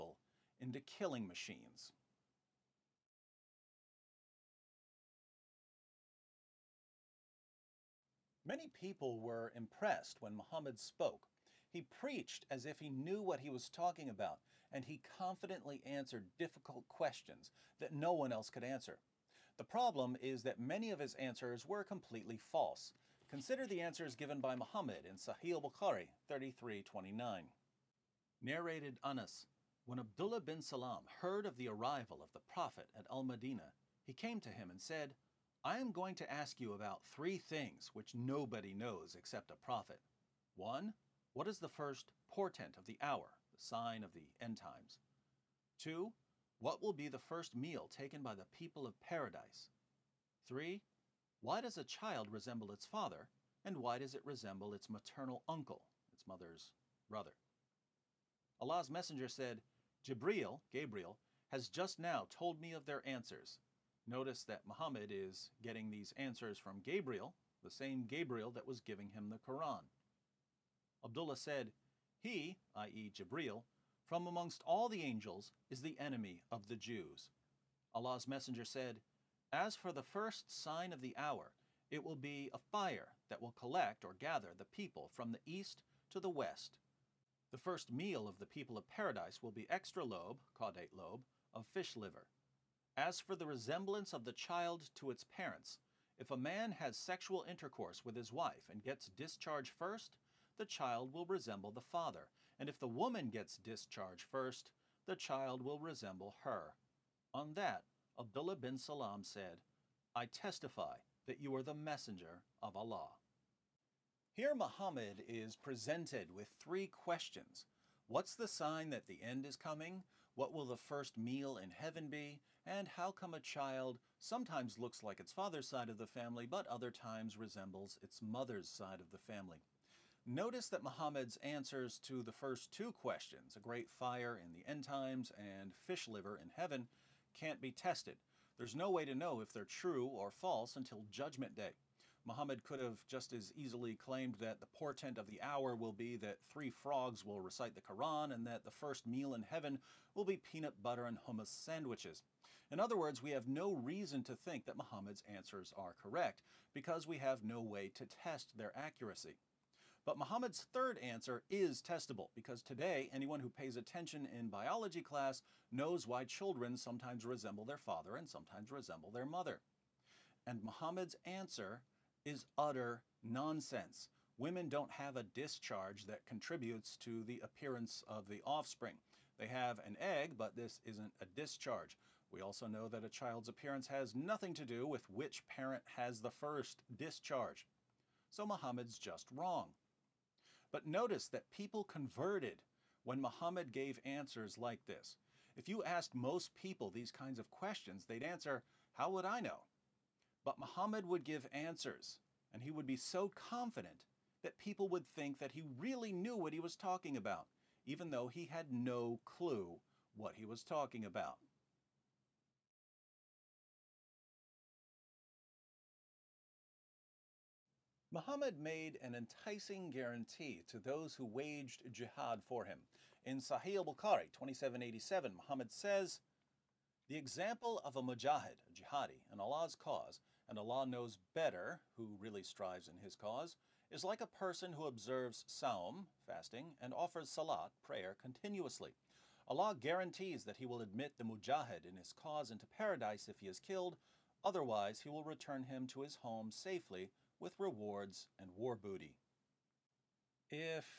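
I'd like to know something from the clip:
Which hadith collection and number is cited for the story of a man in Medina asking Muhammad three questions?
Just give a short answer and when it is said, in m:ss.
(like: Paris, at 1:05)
Sahih Bukhari 33:29, at 0:25.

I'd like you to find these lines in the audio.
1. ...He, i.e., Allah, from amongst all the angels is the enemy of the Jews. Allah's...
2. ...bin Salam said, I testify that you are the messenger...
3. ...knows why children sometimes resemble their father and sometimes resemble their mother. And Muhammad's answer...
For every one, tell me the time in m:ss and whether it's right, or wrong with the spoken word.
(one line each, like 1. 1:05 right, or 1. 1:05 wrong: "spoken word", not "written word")
1. 1:12 wrong: "Jibril", not "Allah"
2. 1:48 right
3. 2:45 right.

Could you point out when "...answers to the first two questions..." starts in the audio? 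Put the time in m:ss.
2:11.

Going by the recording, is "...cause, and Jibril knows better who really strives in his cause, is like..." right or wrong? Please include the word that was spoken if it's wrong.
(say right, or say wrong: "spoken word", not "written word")
wrong: "Allah", not "Jibril".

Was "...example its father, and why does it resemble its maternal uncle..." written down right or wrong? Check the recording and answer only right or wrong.
wrong.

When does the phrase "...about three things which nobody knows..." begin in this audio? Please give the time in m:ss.
0:36.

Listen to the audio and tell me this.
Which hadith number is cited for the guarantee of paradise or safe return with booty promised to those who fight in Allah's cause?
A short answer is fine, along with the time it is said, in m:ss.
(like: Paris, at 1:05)
2787, at 3:44.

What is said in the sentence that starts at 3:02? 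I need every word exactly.
We also know that a child's appearance has nothing to do with which parent has the first discharge.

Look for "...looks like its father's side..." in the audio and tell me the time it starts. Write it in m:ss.
2:04.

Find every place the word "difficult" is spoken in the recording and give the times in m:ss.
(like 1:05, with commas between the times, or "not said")
0:16.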